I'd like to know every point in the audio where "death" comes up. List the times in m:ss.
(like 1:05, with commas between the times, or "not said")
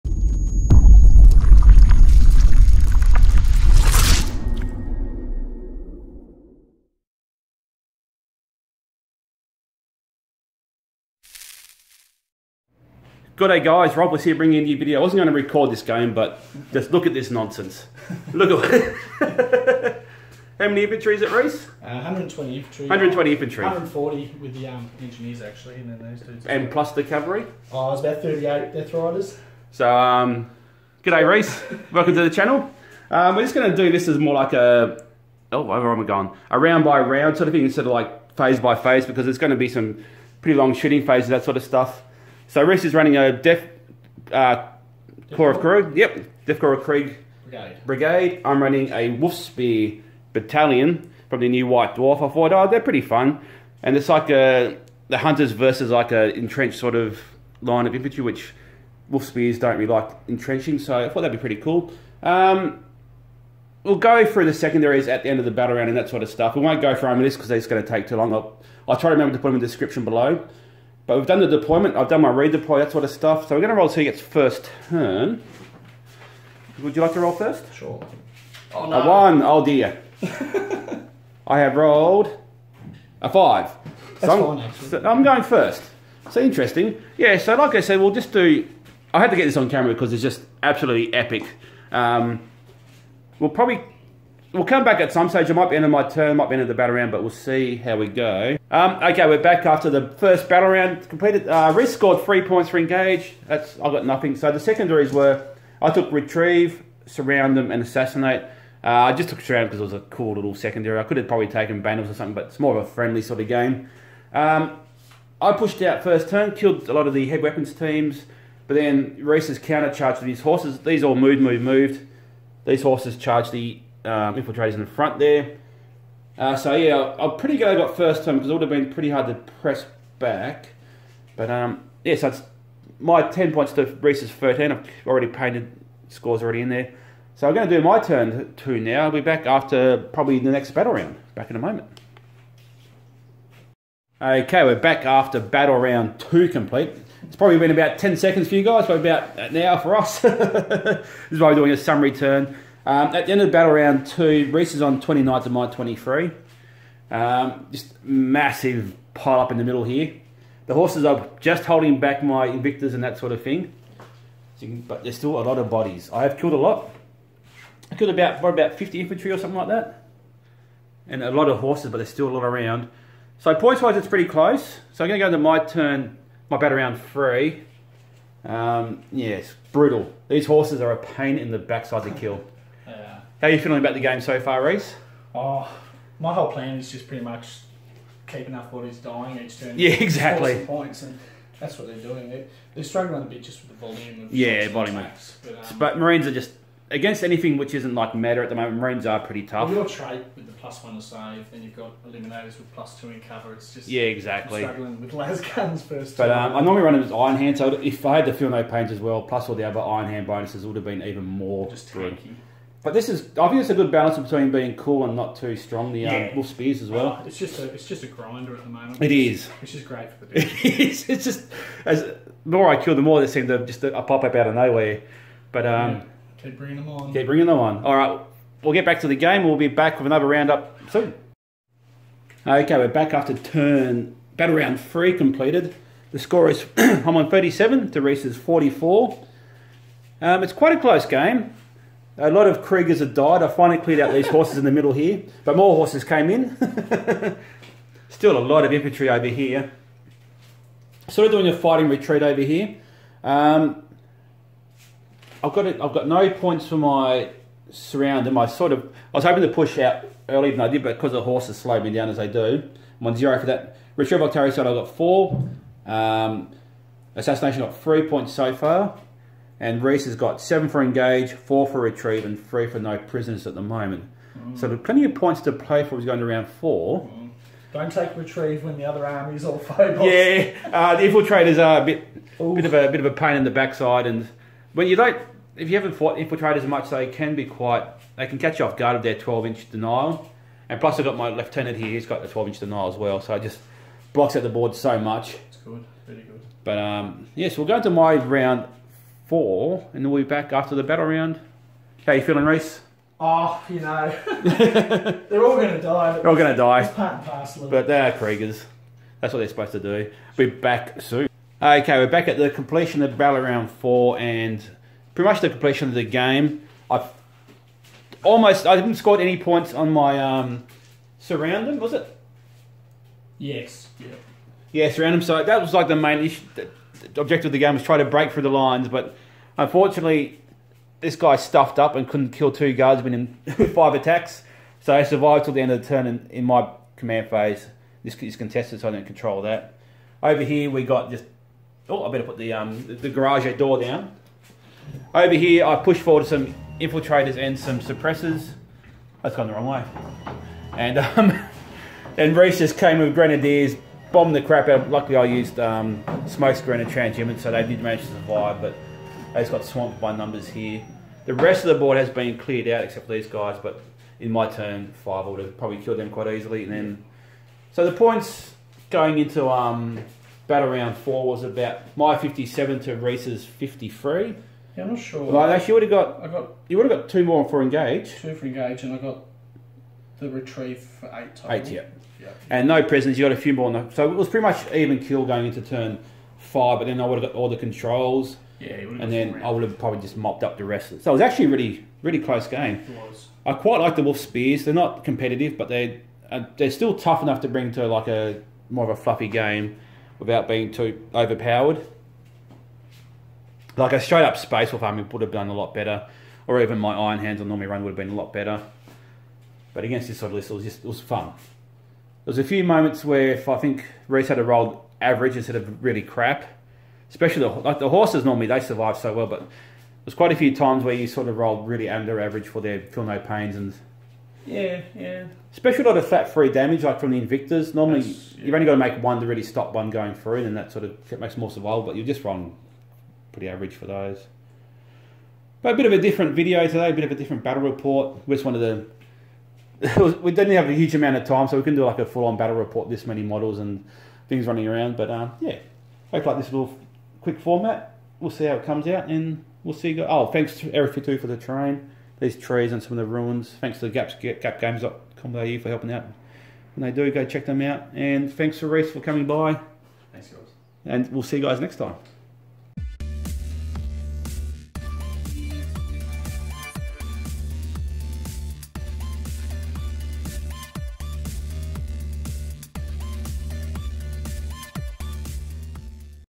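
0:28, 0:46.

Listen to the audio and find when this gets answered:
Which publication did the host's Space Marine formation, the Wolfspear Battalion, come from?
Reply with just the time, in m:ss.
0:51.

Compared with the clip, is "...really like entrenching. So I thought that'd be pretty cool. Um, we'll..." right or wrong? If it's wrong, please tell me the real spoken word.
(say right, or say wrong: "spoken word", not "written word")
right.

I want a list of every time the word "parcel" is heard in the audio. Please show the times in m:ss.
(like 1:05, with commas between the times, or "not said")
5:07.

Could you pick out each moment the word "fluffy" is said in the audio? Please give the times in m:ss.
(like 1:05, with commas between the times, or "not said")
6:39.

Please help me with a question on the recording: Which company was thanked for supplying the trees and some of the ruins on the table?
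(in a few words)
Area 52.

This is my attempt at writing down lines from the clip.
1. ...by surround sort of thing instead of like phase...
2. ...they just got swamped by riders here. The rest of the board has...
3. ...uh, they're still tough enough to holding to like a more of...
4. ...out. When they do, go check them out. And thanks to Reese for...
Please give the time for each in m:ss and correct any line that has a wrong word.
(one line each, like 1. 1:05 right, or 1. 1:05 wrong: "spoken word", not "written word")
1. 0:36 wrong: "round", not "surround"
2. 5:59 wrong: "numbers", not "riders"
3. 6:36 wrong: "bring", not "holding"
4. 7:35 right.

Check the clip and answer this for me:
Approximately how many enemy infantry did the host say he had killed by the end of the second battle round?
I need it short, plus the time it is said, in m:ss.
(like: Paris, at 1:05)
50, at 2:48.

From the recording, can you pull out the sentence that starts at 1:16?
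Would you like to roll first?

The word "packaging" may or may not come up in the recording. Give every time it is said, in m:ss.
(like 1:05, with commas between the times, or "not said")
not said.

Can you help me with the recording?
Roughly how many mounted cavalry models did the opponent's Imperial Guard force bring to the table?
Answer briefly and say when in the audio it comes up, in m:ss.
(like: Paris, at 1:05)
38, at 0:28.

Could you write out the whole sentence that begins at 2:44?
So can, but there's still a lot of bodies.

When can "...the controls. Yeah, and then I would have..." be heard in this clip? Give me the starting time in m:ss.
6:27.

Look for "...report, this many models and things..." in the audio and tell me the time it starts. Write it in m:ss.
7:22.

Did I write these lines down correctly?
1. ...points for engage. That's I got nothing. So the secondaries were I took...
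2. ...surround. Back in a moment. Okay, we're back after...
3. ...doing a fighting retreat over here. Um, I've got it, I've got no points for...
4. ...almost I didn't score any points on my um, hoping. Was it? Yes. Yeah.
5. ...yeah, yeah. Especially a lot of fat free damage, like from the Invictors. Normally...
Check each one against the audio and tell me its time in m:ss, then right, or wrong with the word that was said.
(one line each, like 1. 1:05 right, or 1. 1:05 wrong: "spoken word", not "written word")
1. 1:42 right
2. 2:20 wrong: "round", not "surround"
3. 4:11 right
4. 5:18 wrong: "surrounding", not "hoping"
5. 7:04 right.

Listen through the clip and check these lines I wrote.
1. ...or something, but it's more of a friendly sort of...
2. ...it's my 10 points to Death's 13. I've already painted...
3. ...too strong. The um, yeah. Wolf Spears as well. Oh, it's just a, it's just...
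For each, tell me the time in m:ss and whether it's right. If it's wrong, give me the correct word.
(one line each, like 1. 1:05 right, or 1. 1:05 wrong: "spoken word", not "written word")
1. 1:52 right
2. 2:12 wrong: "Reese", not "Death"
3. 3:35 right.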